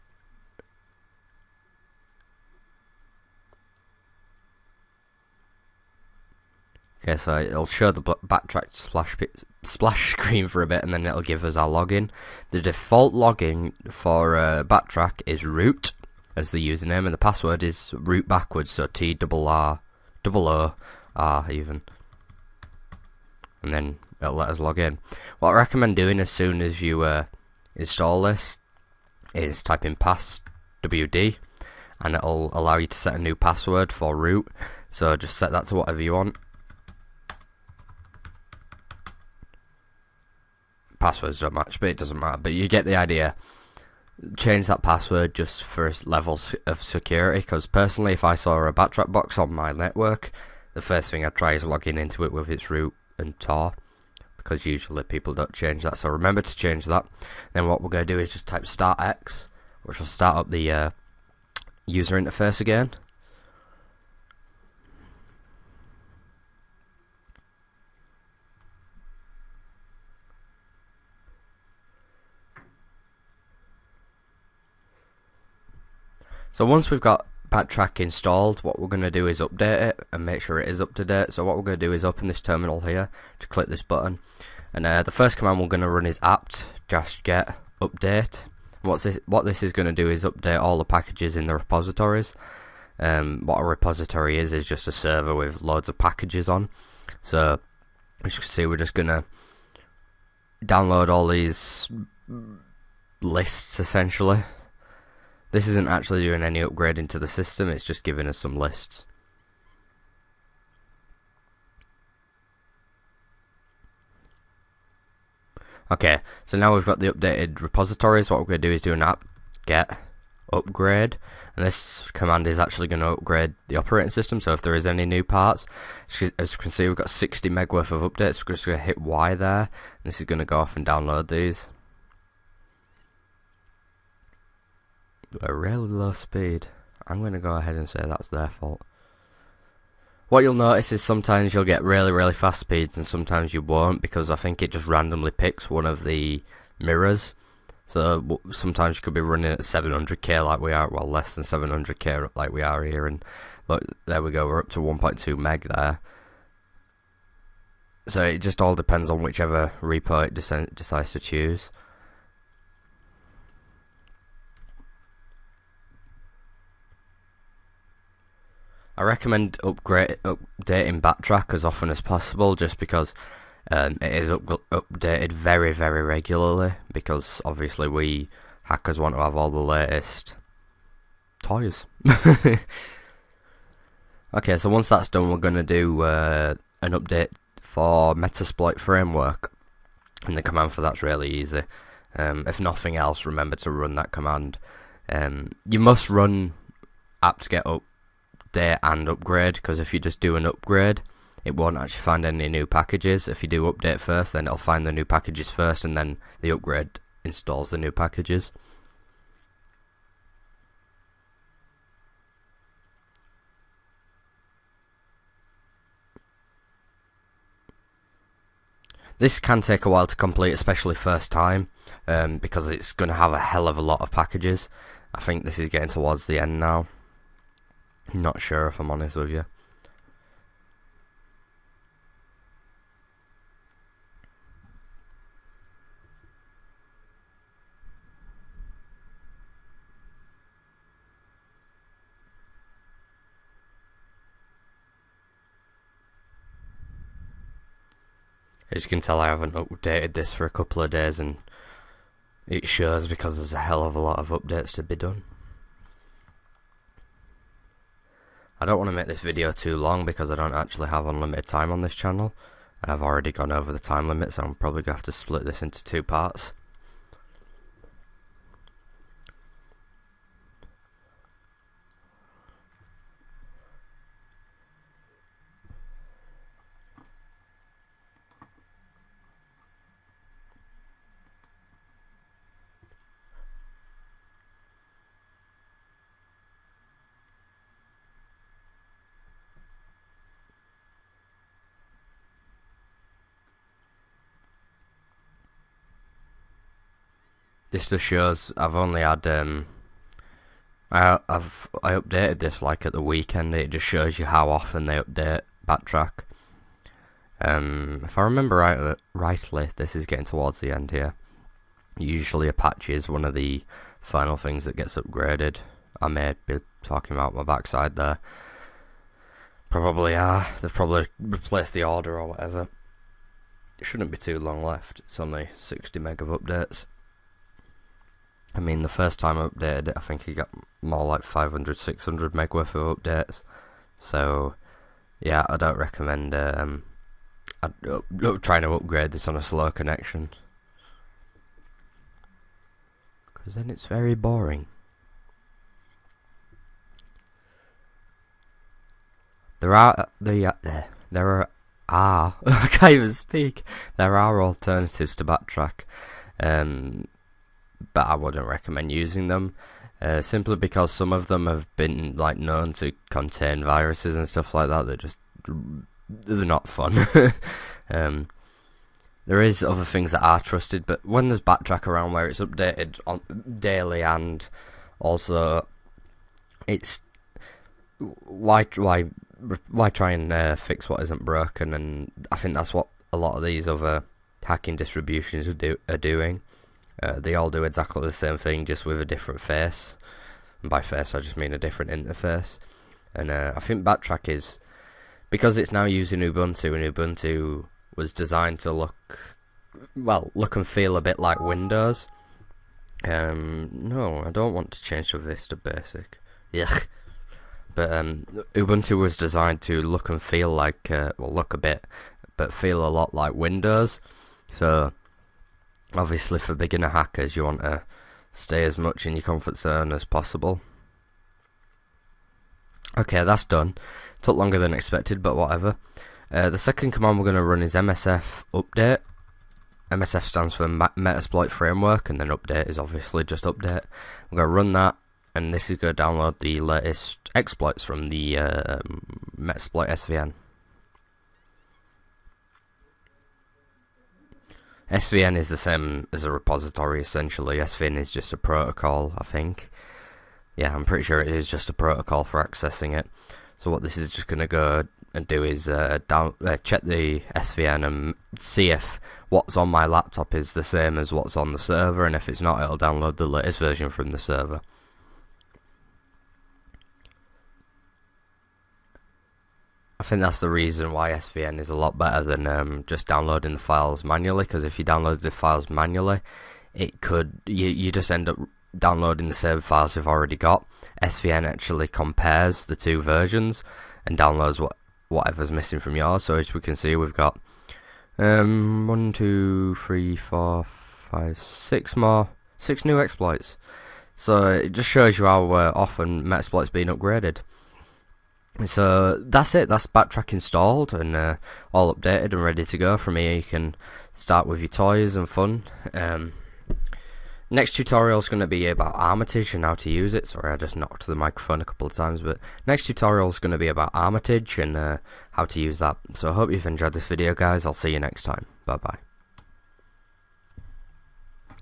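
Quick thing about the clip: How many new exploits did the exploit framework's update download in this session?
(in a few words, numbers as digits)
6.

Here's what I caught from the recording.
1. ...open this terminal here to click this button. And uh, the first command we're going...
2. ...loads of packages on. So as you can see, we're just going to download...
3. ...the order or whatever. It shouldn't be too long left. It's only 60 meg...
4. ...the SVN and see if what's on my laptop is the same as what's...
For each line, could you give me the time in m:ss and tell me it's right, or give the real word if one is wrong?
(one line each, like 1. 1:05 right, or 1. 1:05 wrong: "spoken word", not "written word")
1. 1:22 right
2. 1:35 right
3. 5:21 right
4. 7:36 right.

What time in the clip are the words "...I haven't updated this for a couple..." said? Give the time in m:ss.
4:09.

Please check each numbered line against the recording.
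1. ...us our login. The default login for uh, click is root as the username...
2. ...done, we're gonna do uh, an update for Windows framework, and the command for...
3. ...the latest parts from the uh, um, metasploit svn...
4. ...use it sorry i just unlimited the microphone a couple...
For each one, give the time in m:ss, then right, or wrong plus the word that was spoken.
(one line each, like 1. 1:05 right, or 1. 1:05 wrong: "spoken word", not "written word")
1. 0:11 wrong: "backtrack", not "click"
2. 3:05 wrong: "Metasploit", not "Windows"
3. 7:16 wrong: "exploits", not "parts"
4. 8:29 wrong: "knocked", not "unlimited".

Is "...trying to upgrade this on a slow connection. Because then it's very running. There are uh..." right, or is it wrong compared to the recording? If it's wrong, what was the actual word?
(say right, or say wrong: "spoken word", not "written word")
wrong: "boring", not "running".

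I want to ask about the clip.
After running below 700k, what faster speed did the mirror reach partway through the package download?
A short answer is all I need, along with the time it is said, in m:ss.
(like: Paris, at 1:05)
1.2 meg, at 2:34.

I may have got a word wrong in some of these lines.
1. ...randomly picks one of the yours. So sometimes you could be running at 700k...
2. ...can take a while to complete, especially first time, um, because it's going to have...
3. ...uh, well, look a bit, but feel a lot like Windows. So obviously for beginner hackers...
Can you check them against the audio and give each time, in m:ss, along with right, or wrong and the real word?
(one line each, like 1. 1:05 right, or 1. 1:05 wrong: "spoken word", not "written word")
1. 2:24 wrong: "mirrors", not "yours"
2. 3:39 right
3. 6:50 right.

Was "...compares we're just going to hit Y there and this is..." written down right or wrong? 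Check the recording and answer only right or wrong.
wrong.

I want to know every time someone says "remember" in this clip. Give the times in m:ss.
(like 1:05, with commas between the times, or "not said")
0:56, 3:13, 5:08.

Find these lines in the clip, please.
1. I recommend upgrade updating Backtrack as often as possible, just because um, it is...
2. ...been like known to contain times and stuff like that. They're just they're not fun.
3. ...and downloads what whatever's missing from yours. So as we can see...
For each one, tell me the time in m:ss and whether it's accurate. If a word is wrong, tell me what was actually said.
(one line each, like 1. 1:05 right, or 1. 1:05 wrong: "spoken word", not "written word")
1. 2:48 right
2. 6:01 wrong: "viruses", not "times"
3. 8:04 right.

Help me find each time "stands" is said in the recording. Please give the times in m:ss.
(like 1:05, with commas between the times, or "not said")
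7:10.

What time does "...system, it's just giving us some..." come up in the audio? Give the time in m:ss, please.
1:47.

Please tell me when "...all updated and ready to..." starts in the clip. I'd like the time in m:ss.
8:21.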